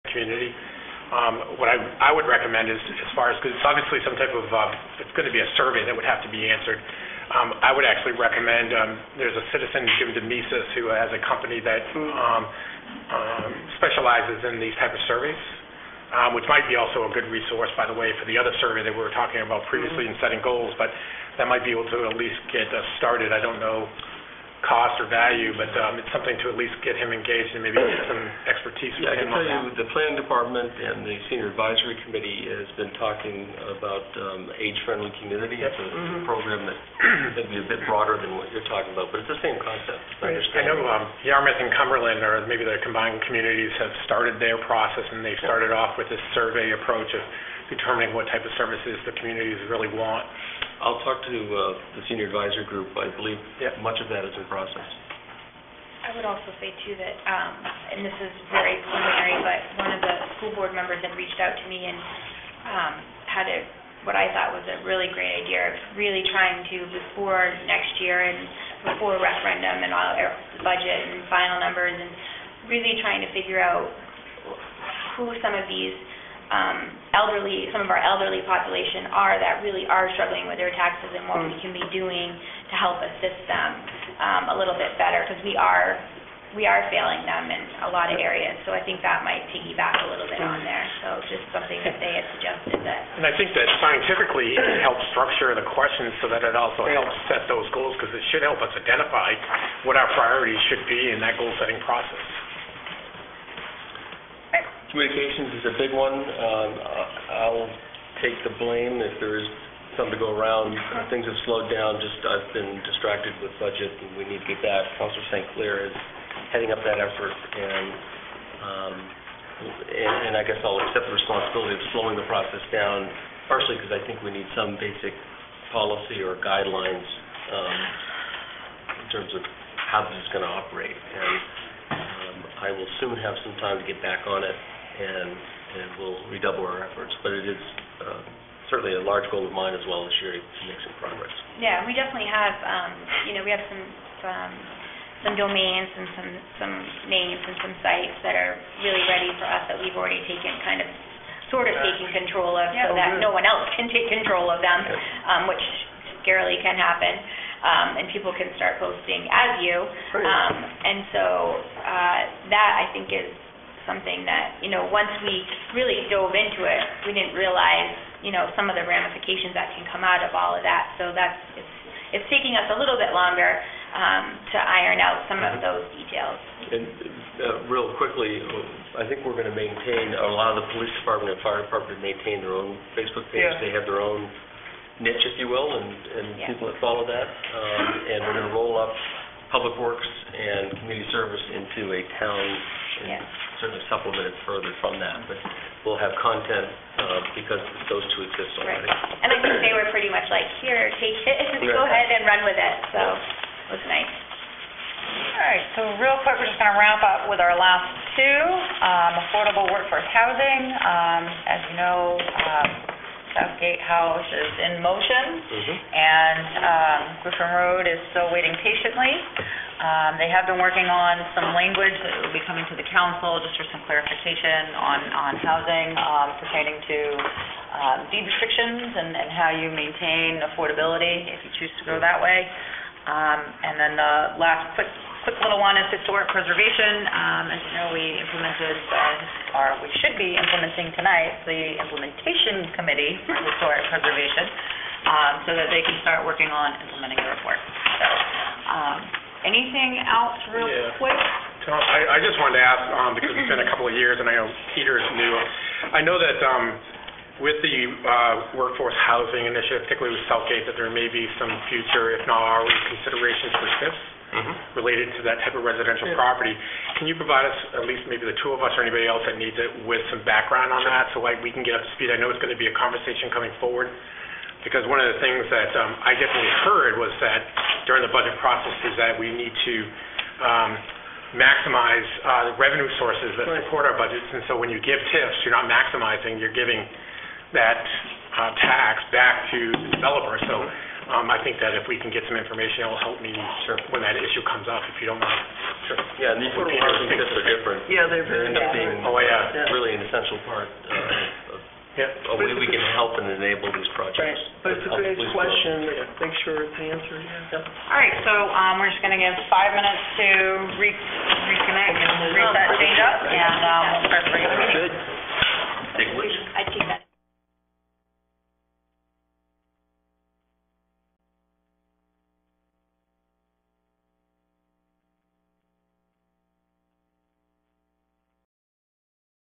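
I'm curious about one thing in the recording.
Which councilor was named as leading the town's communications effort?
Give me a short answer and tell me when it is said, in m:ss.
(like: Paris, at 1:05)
Councilor St. Clair, at 1:54.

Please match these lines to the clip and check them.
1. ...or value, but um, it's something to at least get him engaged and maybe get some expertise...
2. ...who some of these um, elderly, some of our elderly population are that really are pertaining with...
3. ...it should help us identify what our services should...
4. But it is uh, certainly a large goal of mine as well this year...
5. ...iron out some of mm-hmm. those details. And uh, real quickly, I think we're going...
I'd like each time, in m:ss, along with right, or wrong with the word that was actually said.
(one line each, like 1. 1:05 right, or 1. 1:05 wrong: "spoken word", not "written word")
1. 0:25 right
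2. 1:15 wrong: "struggling", not "pertaining"
3. 1:38 wrong: "priorities", not "services"
4. 2:17 right
5. 2:54 right.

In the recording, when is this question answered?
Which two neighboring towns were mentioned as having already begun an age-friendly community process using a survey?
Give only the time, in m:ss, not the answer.
0:41.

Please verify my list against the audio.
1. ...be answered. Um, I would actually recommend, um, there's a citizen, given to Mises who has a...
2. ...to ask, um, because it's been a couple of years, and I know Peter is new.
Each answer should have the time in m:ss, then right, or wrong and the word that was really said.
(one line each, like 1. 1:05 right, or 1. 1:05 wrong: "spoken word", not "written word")
1. 0:06 right
2. 4:12 right.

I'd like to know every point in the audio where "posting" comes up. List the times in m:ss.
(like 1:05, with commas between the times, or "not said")
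2:38.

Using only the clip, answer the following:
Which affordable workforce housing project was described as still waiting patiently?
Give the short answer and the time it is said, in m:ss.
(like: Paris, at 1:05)
Griffin Road, at 3:37.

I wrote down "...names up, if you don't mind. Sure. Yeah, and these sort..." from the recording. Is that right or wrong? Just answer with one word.
wrong.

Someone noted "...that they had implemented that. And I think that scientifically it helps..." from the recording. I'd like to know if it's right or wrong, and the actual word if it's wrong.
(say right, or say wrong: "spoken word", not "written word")
wrong: "suggested", not "implemented".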